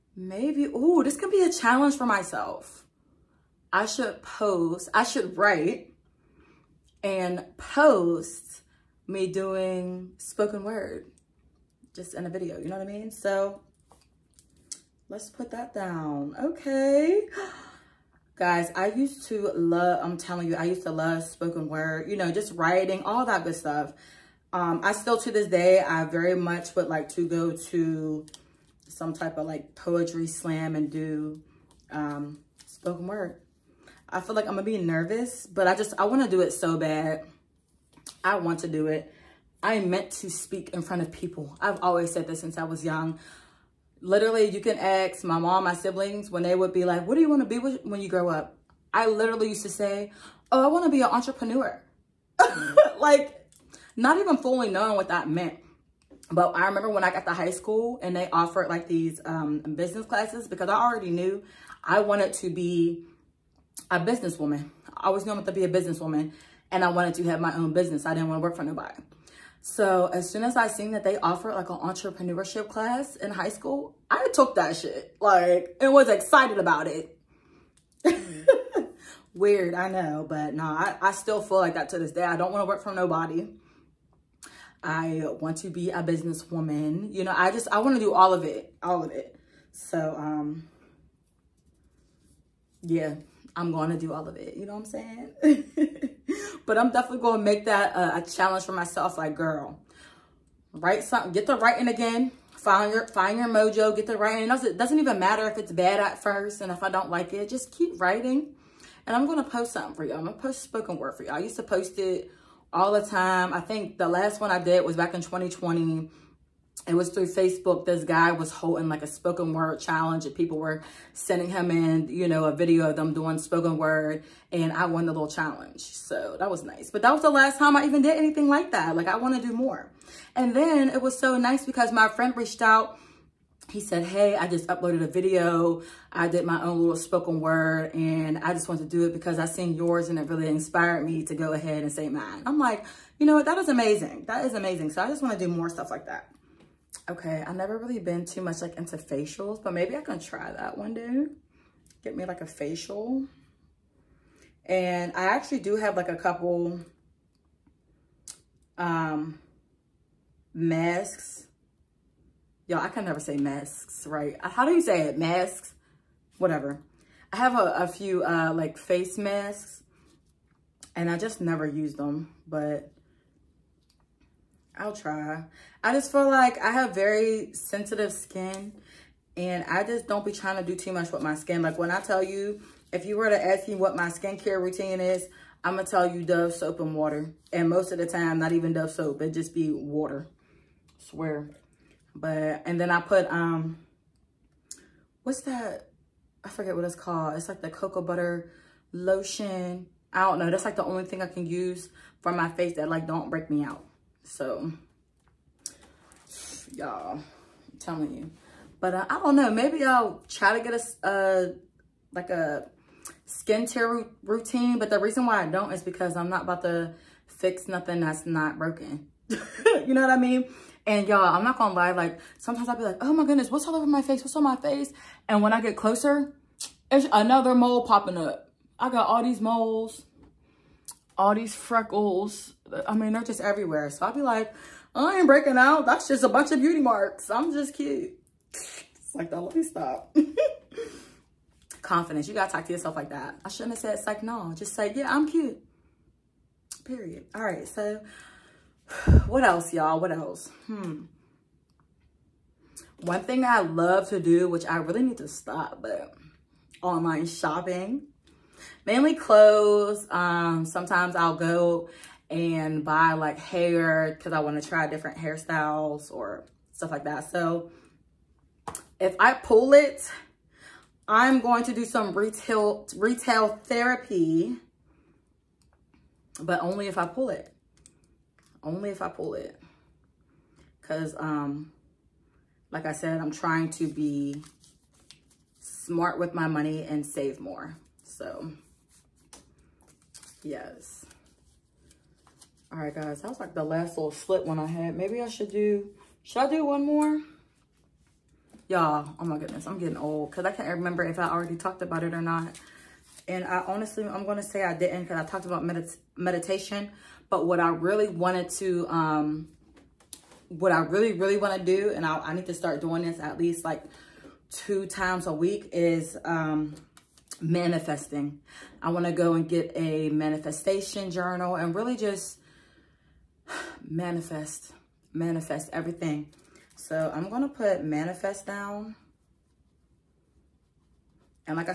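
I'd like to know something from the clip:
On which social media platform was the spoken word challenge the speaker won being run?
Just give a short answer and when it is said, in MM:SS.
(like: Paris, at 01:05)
Facebook, at 01:57.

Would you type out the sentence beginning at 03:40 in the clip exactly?
And y'all, I'm not gonna lie, like sometimes I'll be like, oh my goodness, what's all over my face?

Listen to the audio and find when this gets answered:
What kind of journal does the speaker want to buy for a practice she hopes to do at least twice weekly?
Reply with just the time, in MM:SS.
05:20.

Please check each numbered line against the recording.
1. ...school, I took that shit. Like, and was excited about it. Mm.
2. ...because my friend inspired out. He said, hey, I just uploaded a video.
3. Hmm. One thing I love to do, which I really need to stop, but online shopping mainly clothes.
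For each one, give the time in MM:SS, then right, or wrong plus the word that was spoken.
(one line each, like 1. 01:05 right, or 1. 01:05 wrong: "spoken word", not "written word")
1. 01:13 right
2. 02:11 wrong: "reached", not "inspired"
3. 04:10 right.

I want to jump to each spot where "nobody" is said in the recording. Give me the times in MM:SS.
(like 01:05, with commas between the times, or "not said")
01:08, 01:22.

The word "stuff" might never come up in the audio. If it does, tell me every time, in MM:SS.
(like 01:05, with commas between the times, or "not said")
00:23, 02:25, 04:26.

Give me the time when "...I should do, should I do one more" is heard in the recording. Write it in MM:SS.
04:55.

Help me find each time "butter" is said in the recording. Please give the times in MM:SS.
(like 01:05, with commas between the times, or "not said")
03:18.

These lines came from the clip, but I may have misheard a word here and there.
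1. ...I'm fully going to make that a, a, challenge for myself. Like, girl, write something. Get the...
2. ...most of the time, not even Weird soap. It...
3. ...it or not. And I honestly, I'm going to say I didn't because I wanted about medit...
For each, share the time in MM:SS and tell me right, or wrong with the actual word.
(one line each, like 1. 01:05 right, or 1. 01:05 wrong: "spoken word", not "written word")
1. 01:36 wrong: "definitely", not "fully"
2. 03:07 wrong: "Dove", not "Weird"
3. 05:02 wrong: "talked", not "wanted".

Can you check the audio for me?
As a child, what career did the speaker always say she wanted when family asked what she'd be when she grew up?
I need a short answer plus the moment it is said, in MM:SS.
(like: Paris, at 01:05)
entrepreneur, at 00:51.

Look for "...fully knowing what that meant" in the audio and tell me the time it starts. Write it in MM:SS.
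00:54.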